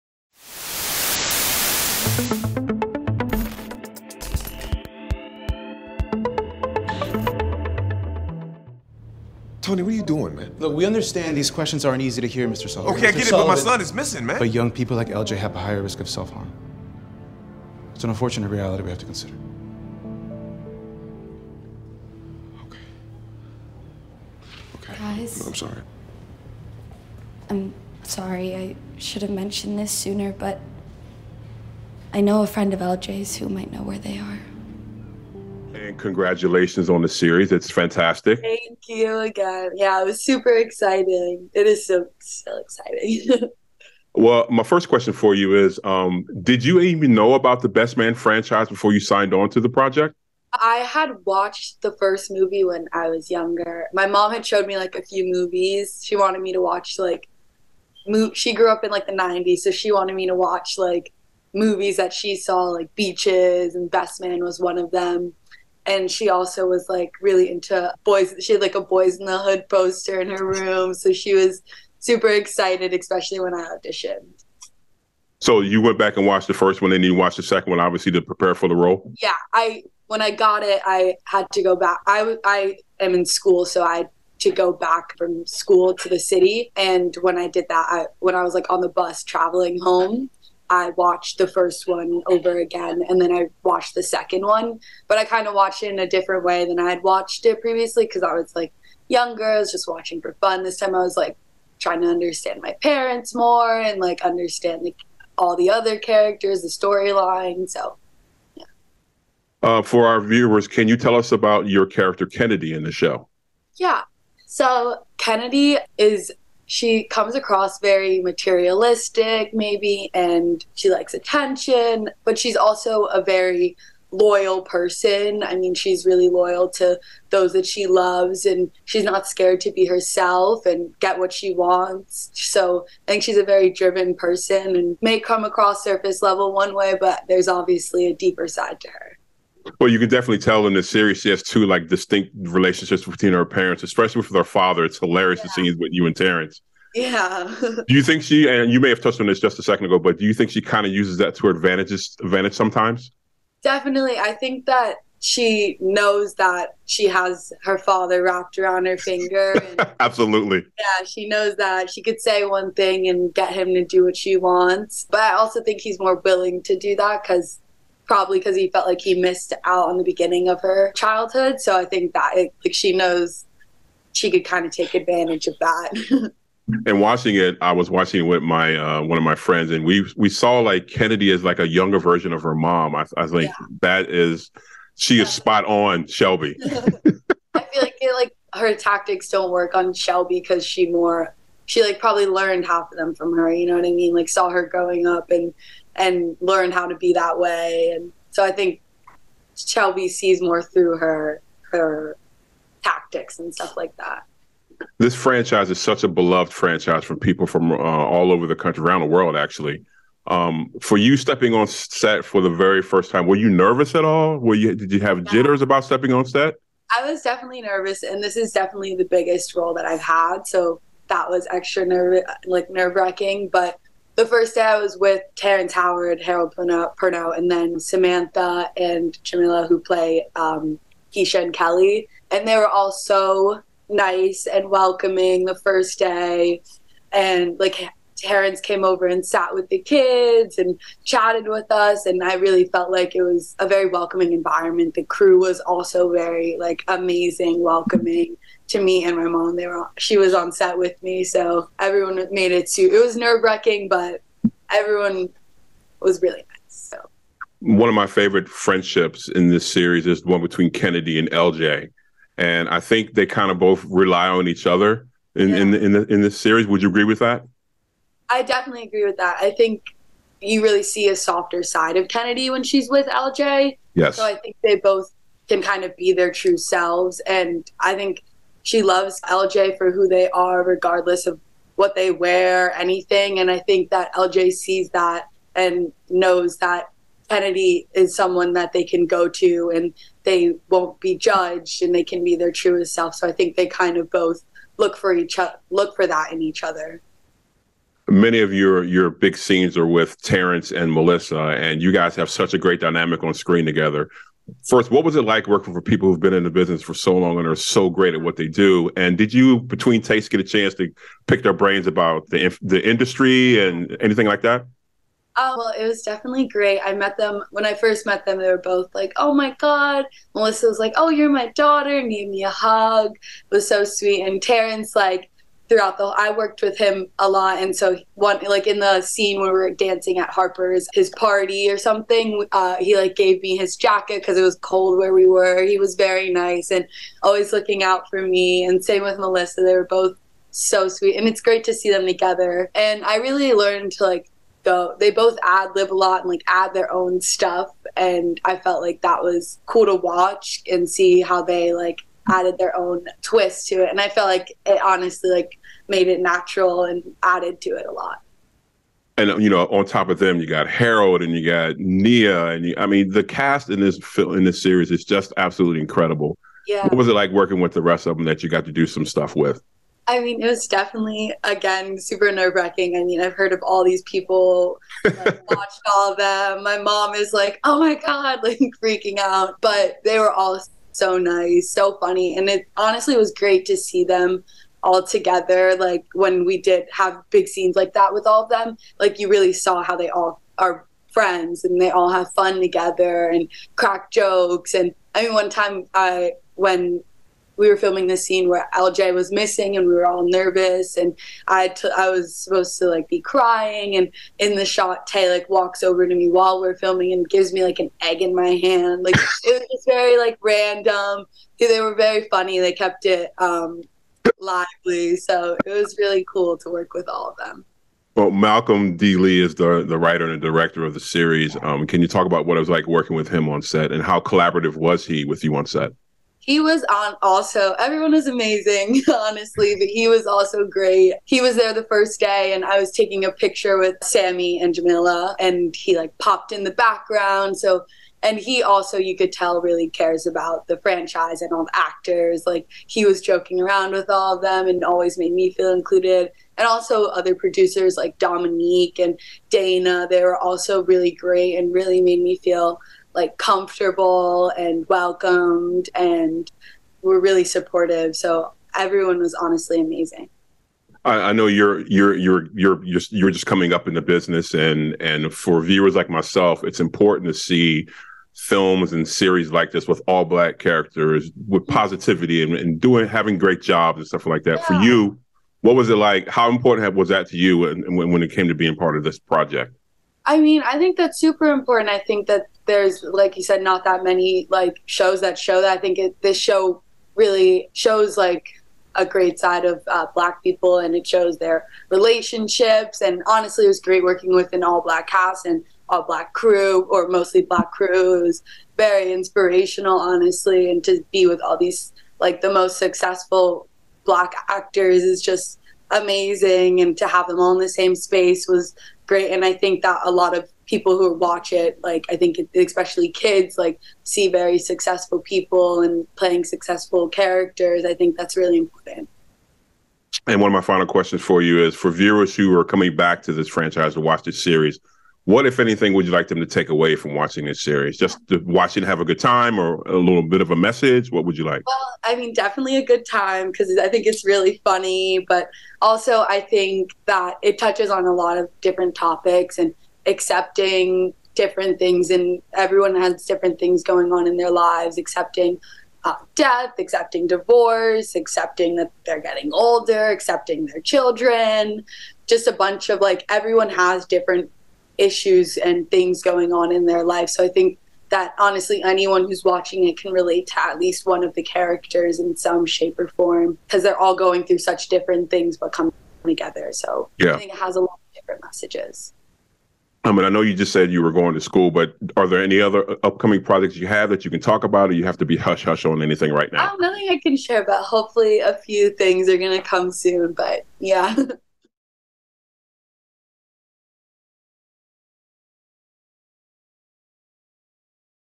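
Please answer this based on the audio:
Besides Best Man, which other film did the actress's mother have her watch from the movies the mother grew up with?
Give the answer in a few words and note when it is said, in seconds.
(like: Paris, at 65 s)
Beaches, at 62 s.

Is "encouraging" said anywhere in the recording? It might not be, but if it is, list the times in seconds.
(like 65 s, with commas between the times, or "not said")
not said.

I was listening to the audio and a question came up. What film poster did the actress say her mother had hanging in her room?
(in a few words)
Boys in the Hood.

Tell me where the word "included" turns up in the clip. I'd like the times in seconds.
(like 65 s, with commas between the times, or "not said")
445 s.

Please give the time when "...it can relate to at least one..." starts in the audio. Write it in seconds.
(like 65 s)
559 s.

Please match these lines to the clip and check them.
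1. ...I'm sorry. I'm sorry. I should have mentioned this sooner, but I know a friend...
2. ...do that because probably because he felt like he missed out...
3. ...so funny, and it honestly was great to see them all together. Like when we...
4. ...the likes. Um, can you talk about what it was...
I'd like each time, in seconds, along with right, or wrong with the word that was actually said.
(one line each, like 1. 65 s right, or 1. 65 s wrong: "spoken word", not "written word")
1. 25 s right
2. 166 s right
3. 381 s right
4. 420 s wrong: "series", not "likes".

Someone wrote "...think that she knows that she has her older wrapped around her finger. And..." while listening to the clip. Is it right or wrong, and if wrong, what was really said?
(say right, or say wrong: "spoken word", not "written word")
wrong: "father", not "older".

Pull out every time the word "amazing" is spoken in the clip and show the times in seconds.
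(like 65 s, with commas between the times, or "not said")
246 s, 428 s, 459 s, 505 s.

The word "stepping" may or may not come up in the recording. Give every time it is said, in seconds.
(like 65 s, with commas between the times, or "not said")
211 s, 215 s.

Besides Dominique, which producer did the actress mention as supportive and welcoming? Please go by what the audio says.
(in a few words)
Dana.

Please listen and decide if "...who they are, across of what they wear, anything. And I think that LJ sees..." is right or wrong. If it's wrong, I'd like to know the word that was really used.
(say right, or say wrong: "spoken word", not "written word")
wrong: "regardless", not "across".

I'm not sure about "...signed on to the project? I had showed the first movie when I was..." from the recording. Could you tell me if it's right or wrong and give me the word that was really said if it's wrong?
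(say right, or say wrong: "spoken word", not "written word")
wrong: "watched", not "showed".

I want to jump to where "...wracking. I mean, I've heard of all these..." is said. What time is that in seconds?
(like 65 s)
372 s.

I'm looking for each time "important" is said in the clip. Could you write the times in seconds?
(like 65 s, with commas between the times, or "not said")
466 s, 476 s, 481 s, 518 s.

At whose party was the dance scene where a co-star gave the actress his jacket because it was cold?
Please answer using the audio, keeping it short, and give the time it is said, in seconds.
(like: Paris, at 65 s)
Harper, at 330 s.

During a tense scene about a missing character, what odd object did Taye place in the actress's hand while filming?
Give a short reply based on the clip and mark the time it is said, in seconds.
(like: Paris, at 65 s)
An egg, at 407 s.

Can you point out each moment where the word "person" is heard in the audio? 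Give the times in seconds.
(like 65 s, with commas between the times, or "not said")
124 s, 134 s.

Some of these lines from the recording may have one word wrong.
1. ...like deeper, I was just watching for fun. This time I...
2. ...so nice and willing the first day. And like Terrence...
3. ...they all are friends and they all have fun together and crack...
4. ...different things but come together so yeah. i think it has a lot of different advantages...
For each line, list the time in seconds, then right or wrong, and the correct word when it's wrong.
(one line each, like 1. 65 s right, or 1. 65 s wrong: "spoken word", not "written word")
1. 98 s wrong: "younger", not "deeper"
2. 232 s wrong: "welcoming", not "willing"
3. 389 s right
4. 564 s wrong: "messages", not "advantages".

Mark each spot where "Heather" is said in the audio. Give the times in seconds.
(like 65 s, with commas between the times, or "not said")
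not said.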